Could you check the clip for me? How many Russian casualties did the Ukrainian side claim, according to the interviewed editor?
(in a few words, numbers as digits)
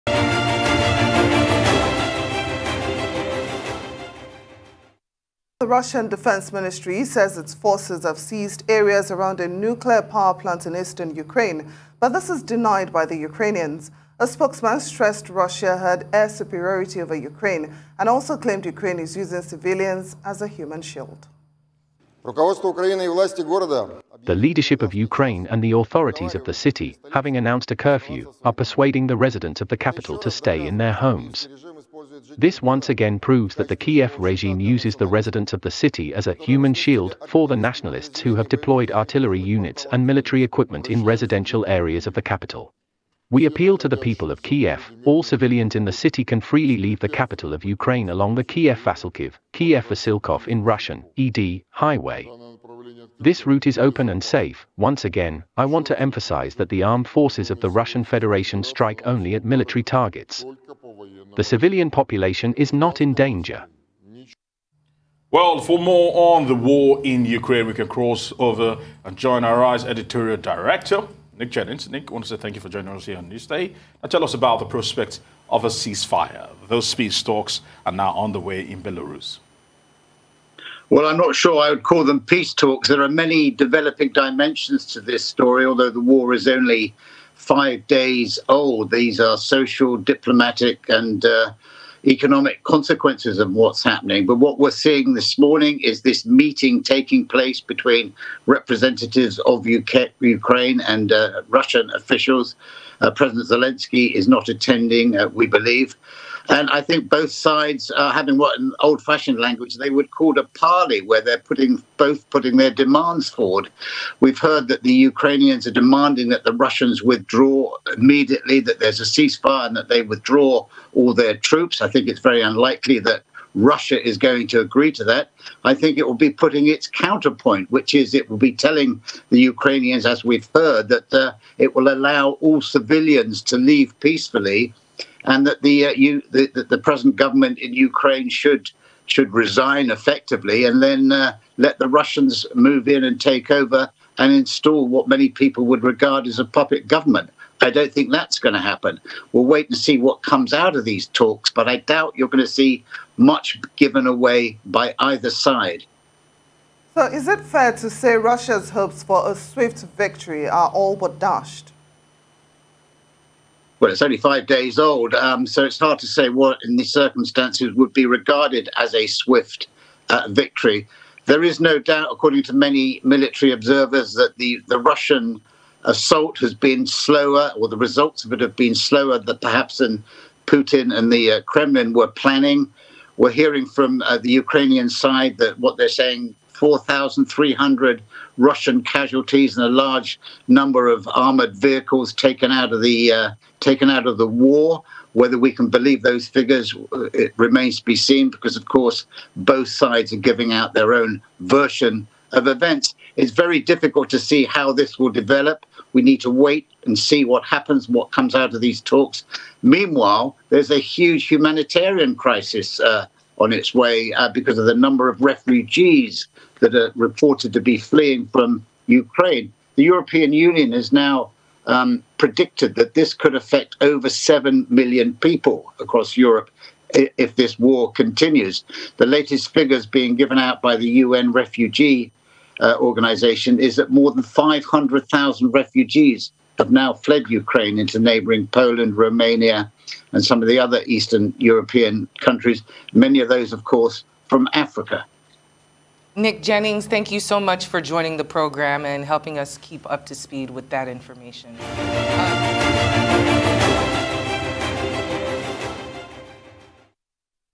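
4,300.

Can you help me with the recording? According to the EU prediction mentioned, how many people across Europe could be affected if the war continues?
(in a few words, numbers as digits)
over 7 million.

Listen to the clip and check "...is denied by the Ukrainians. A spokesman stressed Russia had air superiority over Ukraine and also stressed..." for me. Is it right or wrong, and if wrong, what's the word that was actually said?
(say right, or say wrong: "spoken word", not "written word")
wrong: "claimed", not "stressed".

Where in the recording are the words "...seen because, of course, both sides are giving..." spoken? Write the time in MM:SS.
03:17.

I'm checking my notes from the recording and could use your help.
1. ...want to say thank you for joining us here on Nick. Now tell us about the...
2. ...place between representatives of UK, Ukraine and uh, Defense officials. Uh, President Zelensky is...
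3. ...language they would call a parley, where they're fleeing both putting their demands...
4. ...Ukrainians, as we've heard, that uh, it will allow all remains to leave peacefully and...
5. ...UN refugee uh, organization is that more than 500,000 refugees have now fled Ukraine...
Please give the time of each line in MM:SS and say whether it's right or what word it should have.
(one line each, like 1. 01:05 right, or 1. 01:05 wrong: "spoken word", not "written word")
1. 01:12 wrong: "Newsday", not "Nick"
2. 01:37 wrong: "Russian", not "Defense"
3. 01:49 wrong: "putting", not "fleeing"
4. 02:09 wrong: "civilians", not "remains"
5. 03:51 right.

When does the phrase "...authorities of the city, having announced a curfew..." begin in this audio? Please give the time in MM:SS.
00:25.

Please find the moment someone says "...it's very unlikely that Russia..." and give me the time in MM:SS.
02:02.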